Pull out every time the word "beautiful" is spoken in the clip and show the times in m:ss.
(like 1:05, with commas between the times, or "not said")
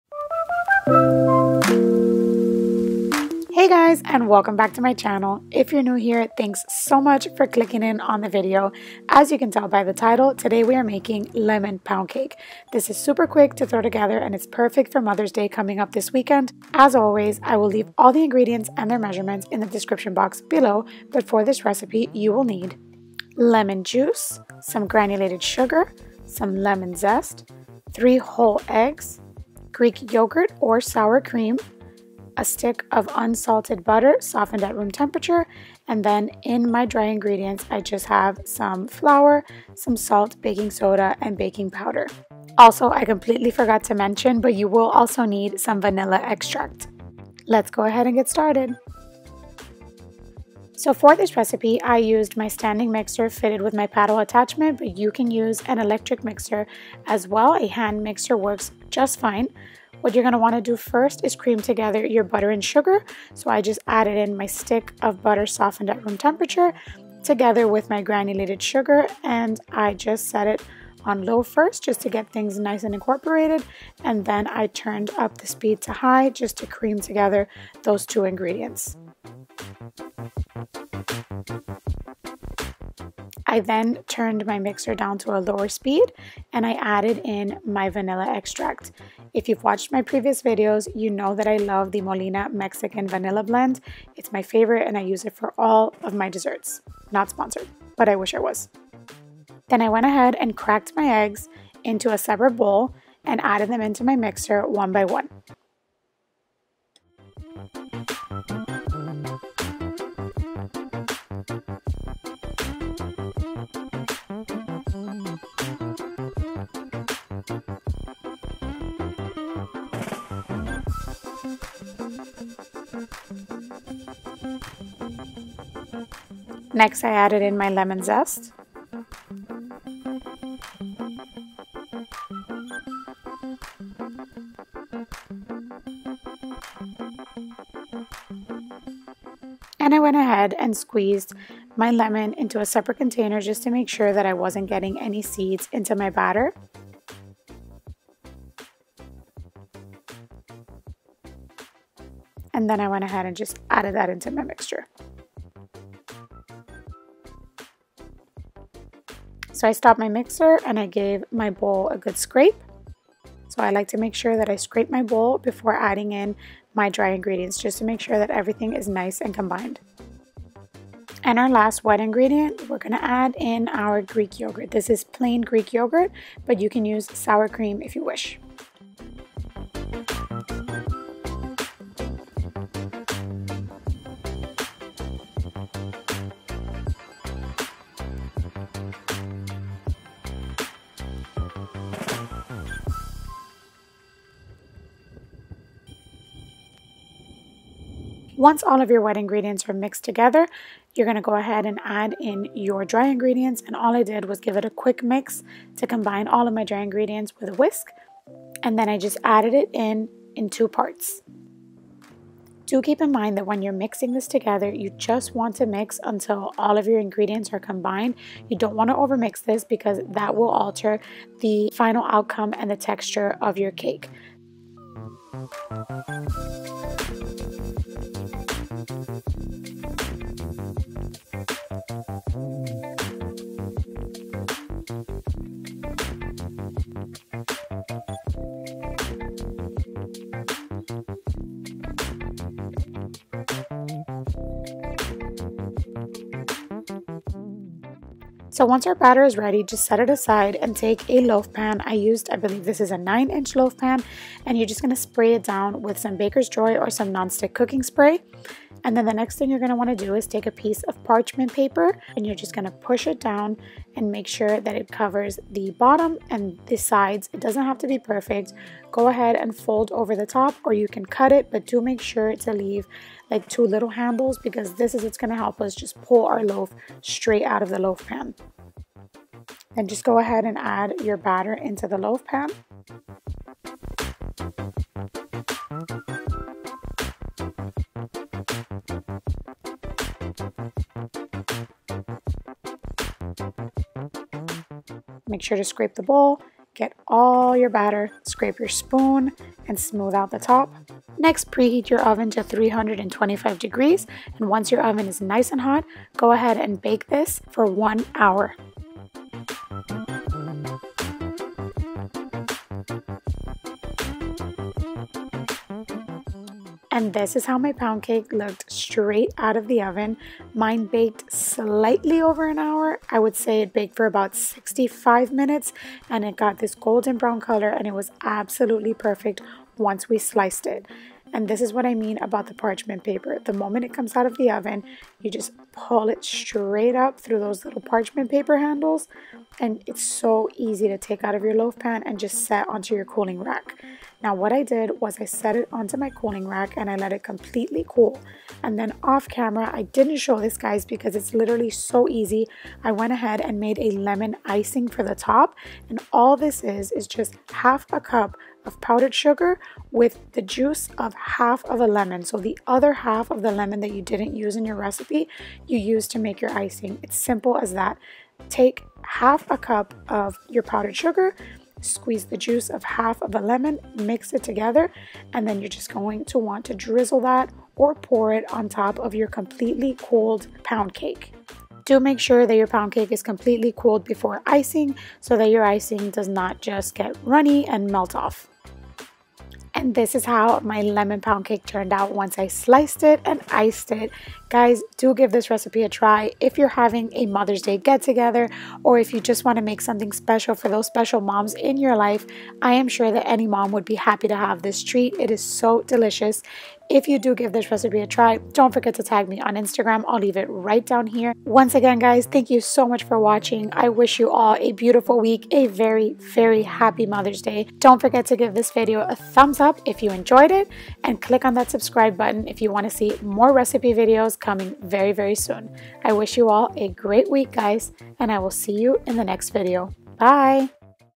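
6:54.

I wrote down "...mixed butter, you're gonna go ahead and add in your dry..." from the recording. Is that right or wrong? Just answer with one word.
wrong.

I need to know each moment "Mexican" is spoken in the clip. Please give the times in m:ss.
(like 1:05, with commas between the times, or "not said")
1:32.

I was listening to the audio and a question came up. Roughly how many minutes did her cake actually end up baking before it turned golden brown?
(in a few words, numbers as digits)
65.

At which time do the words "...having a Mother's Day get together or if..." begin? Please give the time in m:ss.
6:36.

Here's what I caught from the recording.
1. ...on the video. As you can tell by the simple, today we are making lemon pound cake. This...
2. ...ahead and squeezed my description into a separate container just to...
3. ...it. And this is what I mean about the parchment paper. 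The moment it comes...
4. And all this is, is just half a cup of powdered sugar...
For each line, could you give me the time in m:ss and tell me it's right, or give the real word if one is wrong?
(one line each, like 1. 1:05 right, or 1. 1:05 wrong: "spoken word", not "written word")
1. 0:07 wrong: "title", not "simple"
2. 2:20 wrong: "lemon", not "description"
3. 5:30 right
4. 5:55 right.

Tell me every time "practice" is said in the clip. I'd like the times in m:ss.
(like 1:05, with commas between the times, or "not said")
not said.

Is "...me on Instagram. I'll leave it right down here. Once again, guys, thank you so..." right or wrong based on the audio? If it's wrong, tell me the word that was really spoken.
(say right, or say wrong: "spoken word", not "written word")
right.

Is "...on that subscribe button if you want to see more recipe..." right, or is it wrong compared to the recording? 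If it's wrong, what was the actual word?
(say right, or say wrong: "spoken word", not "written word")
right.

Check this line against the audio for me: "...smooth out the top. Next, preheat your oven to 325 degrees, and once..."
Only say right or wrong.
right.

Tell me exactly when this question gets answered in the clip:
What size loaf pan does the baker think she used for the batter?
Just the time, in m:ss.
4:12.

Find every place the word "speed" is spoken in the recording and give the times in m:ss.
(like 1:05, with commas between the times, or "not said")
1:15, 1:25.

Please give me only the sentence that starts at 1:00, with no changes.
What you're gonna wanna do first is cream together your butter and sugar.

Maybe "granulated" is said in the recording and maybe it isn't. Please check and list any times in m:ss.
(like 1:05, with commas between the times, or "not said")
0:24, 1:08.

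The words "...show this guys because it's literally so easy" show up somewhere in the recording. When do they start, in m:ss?
5:50.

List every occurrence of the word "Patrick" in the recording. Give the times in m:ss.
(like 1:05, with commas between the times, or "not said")
not said.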